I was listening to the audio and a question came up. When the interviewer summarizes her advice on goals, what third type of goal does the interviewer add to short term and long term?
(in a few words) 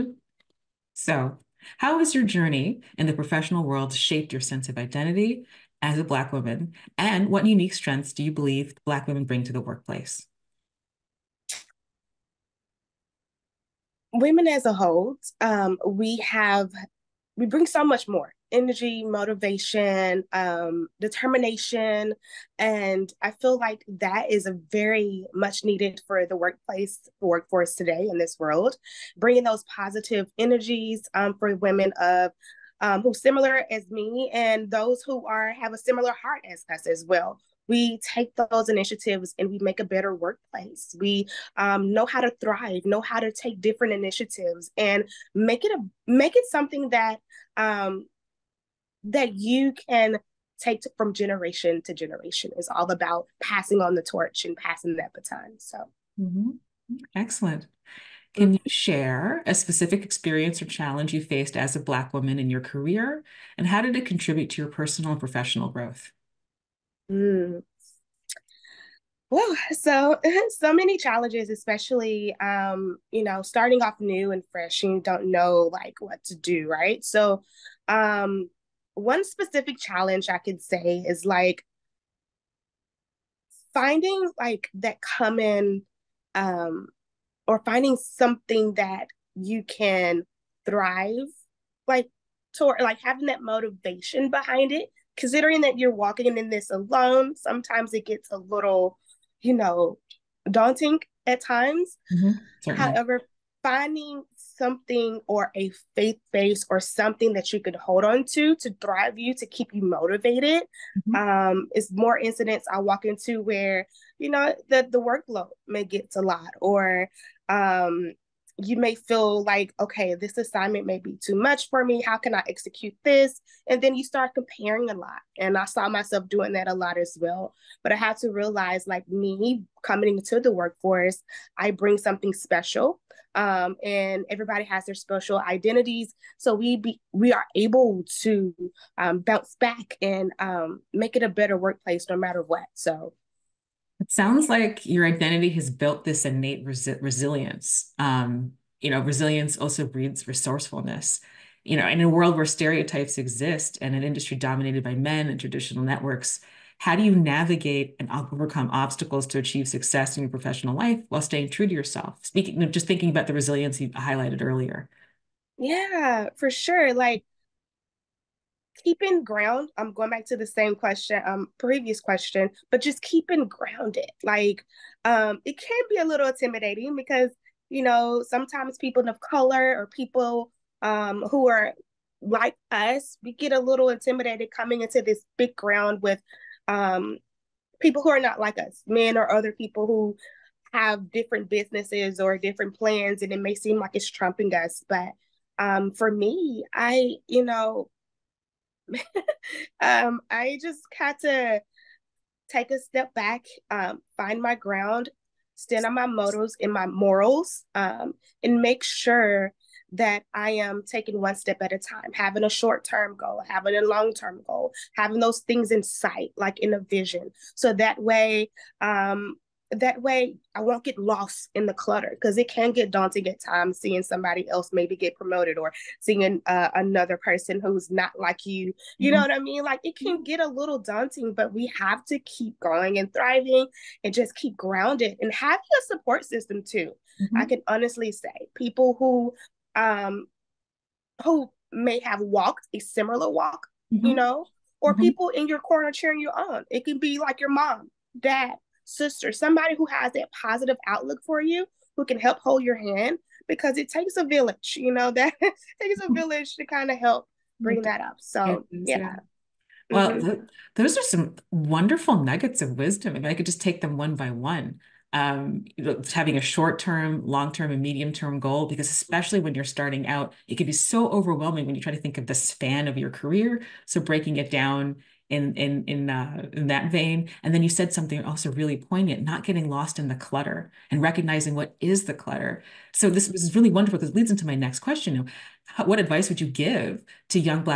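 medium term.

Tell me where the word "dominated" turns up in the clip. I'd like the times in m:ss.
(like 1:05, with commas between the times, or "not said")
2:34.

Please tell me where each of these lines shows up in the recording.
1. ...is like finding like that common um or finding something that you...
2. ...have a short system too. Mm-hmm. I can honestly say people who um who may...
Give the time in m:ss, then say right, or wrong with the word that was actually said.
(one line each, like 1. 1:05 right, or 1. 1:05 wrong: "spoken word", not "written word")
1. 1:21 right
2. 3:55 wrong: "support", not "short".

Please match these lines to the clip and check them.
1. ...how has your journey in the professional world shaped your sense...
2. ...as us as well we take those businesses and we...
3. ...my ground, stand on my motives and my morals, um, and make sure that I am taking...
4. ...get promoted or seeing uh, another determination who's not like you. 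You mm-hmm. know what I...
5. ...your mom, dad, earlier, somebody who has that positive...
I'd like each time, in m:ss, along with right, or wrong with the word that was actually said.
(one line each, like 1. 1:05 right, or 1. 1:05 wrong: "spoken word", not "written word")
1. 0:01 right
2. 0:36 wrong: "initiatives", not "businesses"
3. 3:24 right
4. 3:44 wrong: "person", not "determination"
5. 4:07 wrong: "sister", not "earlier".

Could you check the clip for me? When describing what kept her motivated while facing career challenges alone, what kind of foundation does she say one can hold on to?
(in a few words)
a faith base.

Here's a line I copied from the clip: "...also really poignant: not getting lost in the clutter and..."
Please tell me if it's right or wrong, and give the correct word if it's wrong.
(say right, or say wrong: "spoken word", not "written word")
right.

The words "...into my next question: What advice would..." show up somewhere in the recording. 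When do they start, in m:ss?
4:44.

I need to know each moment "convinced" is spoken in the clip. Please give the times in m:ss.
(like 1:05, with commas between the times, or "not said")
not said.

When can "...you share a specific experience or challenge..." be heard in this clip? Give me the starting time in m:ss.
0:58.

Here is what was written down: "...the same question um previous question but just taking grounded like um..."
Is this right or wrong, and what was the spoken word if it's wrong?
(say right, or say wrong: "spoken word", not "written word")
wrong: "keeping", not "taking".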